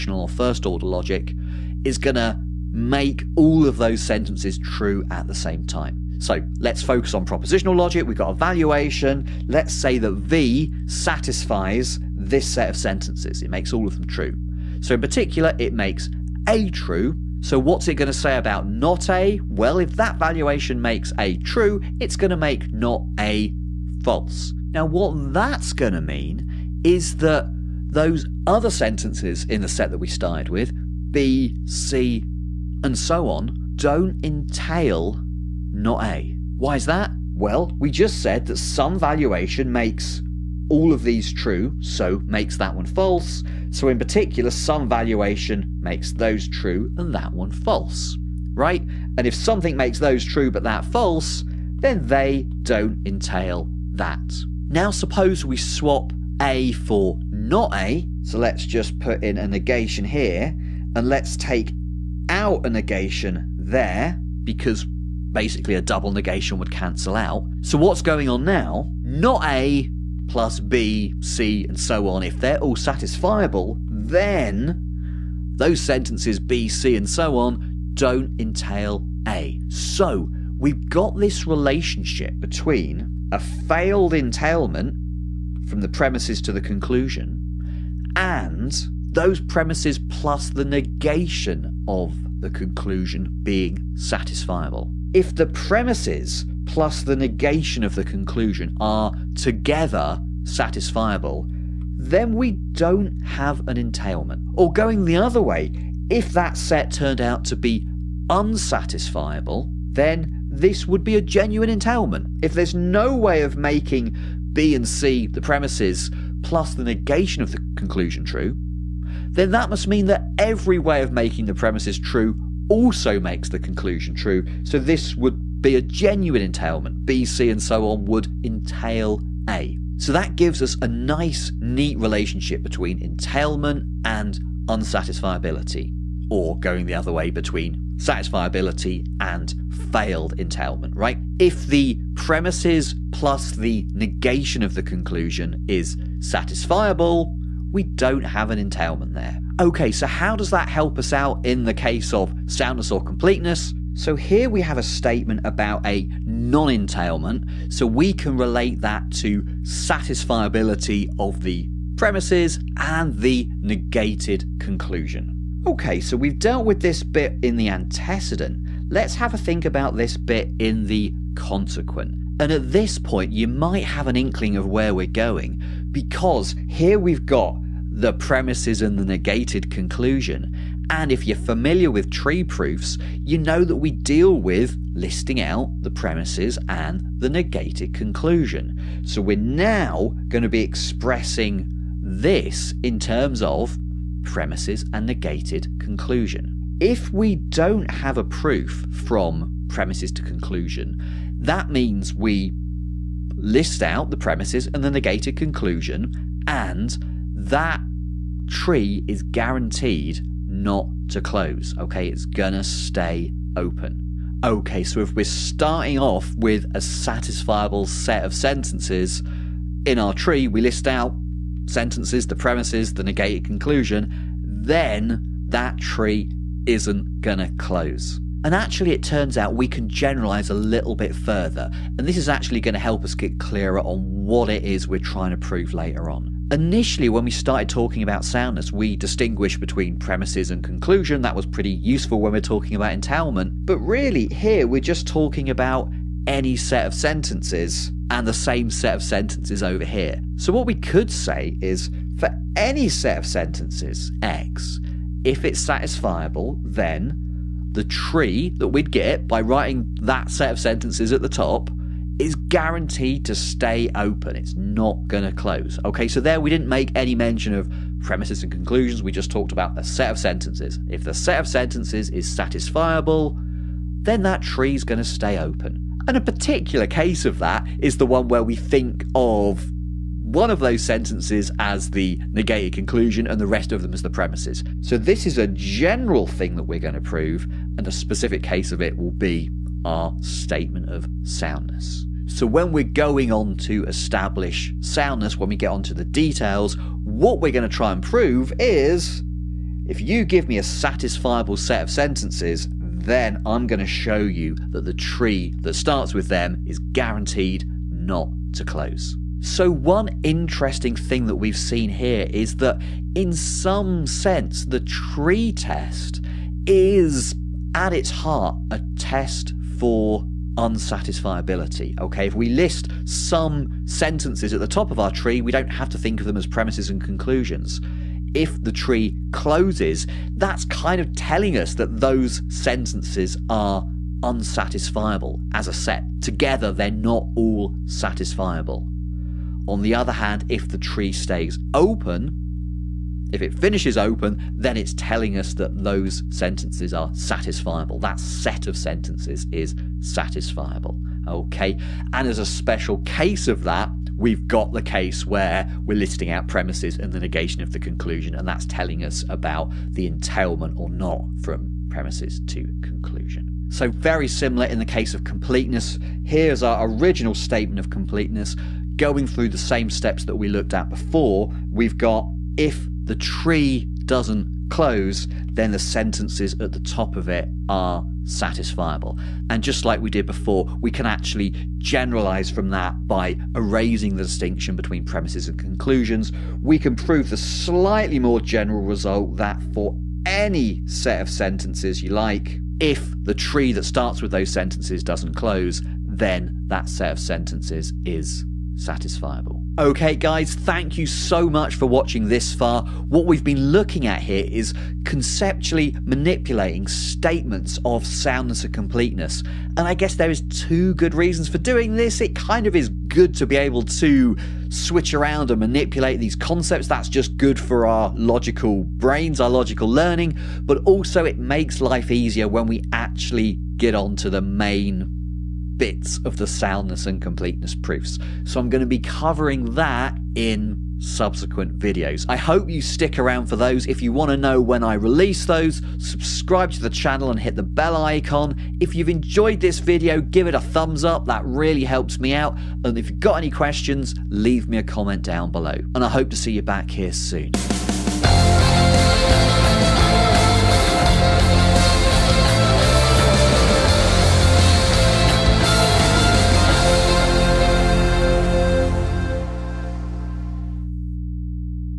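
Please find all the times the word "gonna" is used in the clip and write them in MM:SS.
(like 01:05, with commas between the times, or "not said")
03:32, 03:47.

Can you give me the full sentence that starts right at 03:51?
And this is actually going to help us get clearer on what it is we're trying to prove later on.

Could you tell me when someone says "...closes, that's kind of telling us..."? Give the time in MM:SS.
05:29.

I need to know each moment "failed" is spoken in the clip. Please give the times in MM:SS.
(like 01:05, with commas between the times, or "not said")
01:23, 02:19.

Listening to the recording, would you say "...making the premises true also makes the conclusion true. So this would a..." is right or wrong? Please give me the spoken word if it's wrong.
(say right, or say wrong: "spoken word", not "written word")
right.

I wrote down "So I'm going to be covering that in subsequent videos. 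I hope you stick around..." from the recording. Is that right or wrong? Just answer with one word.
right.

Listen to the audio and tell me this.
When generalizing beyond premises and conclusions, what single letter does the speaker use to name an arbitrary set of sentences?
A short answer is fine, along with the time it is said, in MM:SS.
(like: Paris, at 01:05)
X, at 04:14.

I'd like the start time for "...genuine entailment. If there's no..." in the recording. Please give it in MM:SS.
01:51.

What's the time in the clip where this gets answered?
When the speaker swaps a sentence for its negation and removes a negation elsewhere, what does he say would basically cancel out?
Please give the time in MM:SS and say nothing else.
01:05.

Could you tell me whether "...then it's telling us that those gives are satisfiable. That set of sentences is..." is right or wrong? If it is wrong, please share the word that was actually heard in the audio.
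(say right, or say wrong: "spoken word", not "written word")
wrong: "sentences", not "gives".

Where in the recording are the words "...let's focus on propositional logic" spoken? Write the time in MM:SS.
00:06.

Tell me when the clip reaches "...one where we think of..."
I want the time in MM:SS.
04:38.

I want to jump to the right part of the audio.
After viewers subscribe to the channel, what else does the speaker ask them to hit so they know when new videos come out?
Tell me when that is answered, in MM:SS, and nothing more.
07:17.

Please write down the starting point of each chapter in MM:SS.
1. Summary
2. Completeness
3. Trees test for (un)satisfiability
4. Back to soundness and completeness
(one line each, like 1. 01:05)
1. 06:39
2. 06:03
3. 05:08
4. 02:29.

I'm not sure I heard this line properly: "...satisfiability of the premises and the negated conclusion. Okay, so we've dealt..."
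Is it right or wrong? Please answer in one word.
right.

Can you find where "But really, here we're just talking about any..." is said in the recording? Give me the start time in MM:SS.
04:03.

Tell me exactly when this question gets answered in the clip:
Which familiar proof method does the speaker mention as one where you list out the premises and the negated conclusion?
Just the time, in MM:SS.
03:02.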